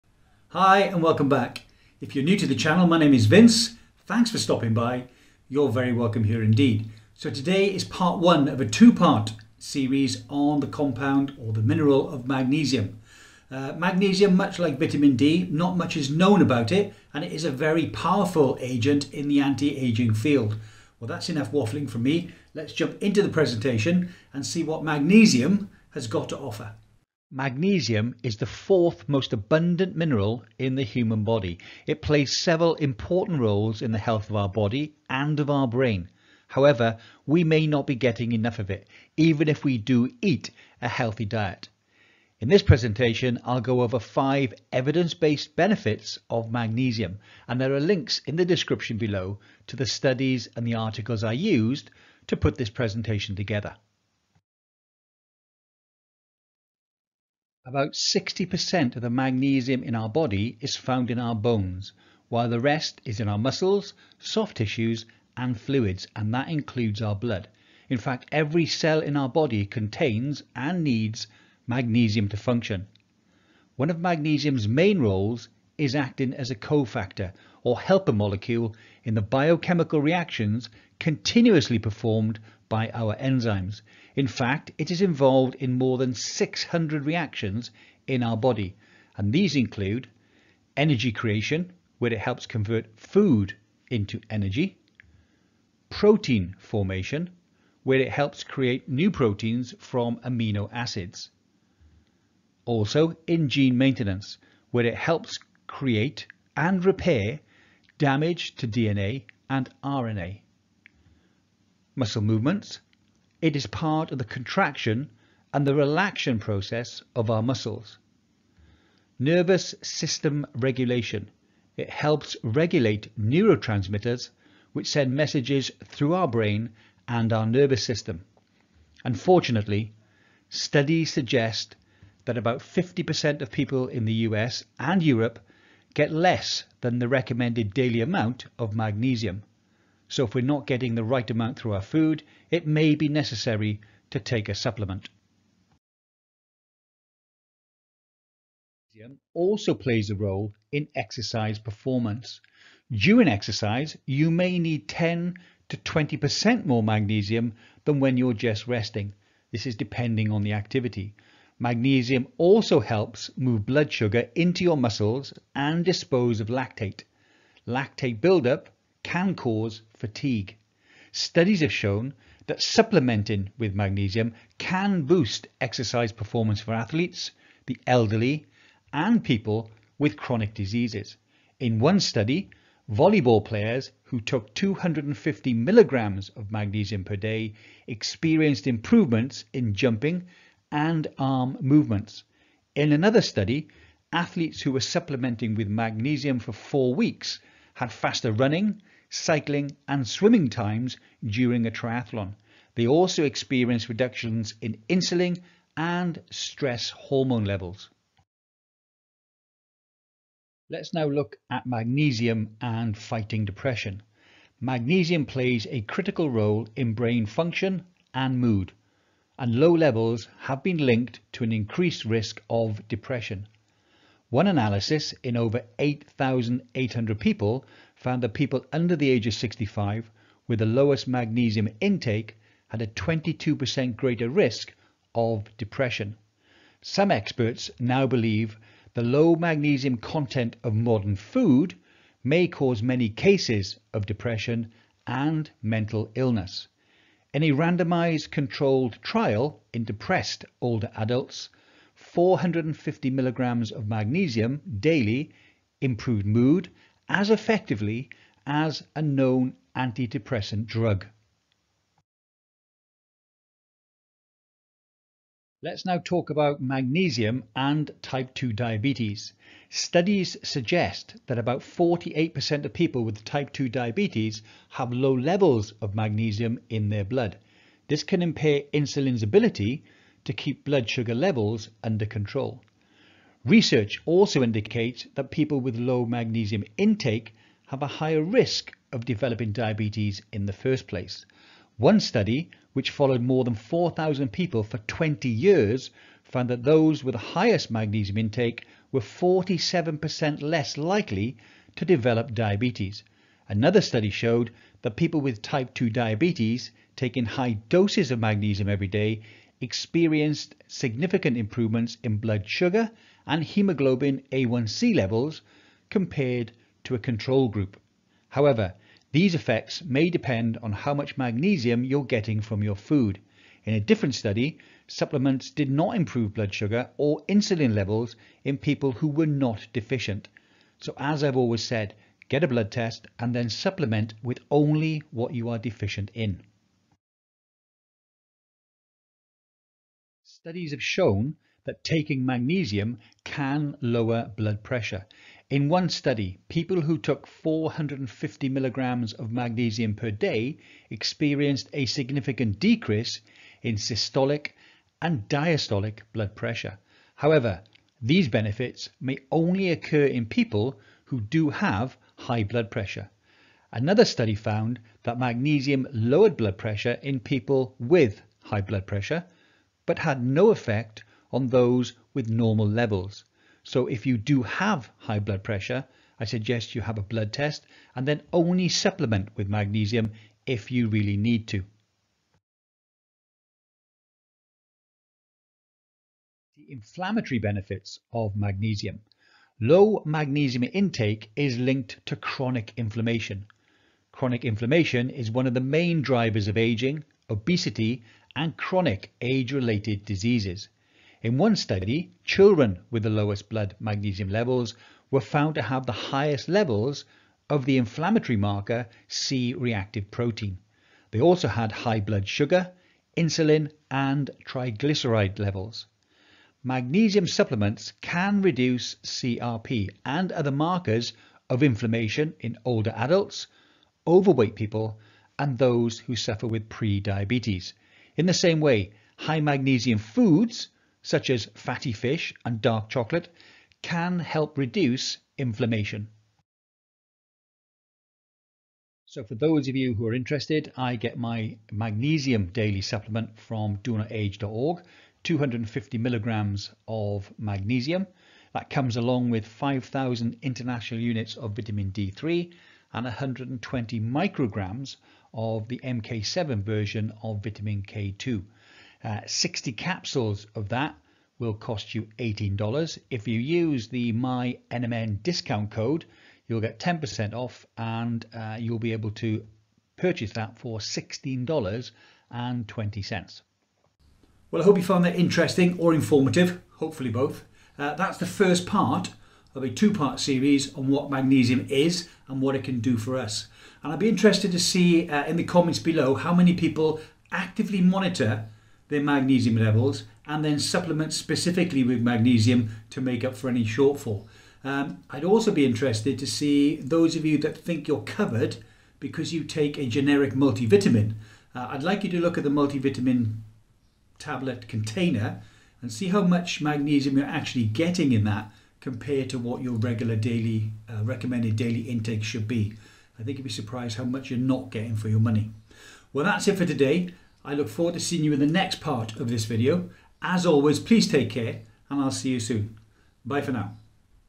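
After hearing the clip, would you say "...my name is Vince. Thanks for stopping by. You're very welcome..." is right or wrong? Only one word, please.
right.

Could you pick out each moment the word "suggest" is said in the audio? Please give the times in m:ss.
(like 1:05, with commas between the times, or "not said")
2:11, 4:30, 6:16.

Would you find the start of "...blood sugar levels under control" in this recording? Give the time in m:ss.
4:40.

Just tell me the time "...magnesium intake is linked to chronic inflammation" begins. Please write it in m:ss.
6:30.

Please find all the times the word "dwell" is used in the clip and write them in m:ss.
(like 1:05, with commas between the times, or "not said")
not said.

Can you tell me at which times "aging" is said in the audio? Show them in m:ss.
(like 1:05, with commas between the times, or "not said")
0:19, 6:36.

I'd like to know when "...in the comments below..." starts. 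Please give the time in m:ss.
8:05.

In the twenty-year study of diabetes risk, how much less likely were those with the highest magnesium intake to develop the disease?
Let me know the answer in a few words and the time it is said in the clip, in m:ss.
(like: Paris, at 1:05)
47%, at 4:59.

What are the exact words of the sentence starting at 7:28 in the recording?
That comes along with 5,000 international units of vitamin D3 and 120 micrograms of the MK7 version of vitamin K2.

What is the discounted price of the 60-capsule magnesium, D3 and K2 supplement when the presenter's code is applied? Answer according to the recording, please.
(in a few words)
$16.20.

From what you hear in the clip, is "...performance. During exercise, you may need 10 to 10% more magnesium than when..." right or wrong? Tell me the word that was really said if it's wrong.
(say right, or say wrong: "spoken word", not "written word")
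wrong: "20", not "10".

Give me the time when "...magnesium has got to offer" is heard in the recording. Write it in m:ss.
0:24.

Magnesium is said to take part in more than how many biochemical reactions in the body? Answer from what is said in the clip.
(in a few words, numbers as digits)
600.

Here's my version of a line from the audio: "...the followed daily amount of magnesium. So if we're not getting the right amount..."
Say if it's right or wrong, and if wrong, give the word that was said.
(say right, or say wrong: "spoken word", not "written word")
wrong: "recommended", not "followed".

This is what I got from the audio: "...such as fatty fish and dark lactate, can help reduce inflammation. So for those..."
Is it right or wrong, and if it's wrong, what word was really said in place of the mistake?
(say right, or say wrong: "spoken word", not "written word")
wrong: "chocolate", not "lactate".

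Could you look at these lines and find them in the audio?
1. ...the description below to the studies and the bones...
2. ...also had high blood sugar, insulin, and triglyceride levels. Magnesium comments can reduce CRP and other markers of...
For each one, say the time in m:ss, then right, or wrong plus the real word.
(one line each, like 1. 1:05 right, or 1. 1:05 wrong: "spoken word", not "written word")
1. 0:48 wrong: "articles", not "bones"
2. 6:51 wrong: "supplements", not "comments".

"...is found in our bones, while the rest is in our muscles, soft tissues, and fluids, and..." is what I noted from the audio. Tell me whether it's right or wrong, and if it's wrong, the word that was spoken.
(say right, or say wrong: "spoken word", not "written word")
right.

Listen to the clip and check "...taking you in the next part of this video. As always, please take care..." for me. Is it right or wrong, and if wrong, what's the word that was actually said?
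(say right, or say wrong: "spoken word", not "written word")
wrong: "seeing", not "taking".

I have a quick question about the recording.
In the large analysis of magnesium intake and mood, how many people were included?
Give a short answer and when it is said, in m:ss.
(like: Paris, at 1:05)
over 8,800, at 3:45.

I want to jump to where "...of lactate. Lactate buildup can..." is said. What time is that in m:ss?
2:46.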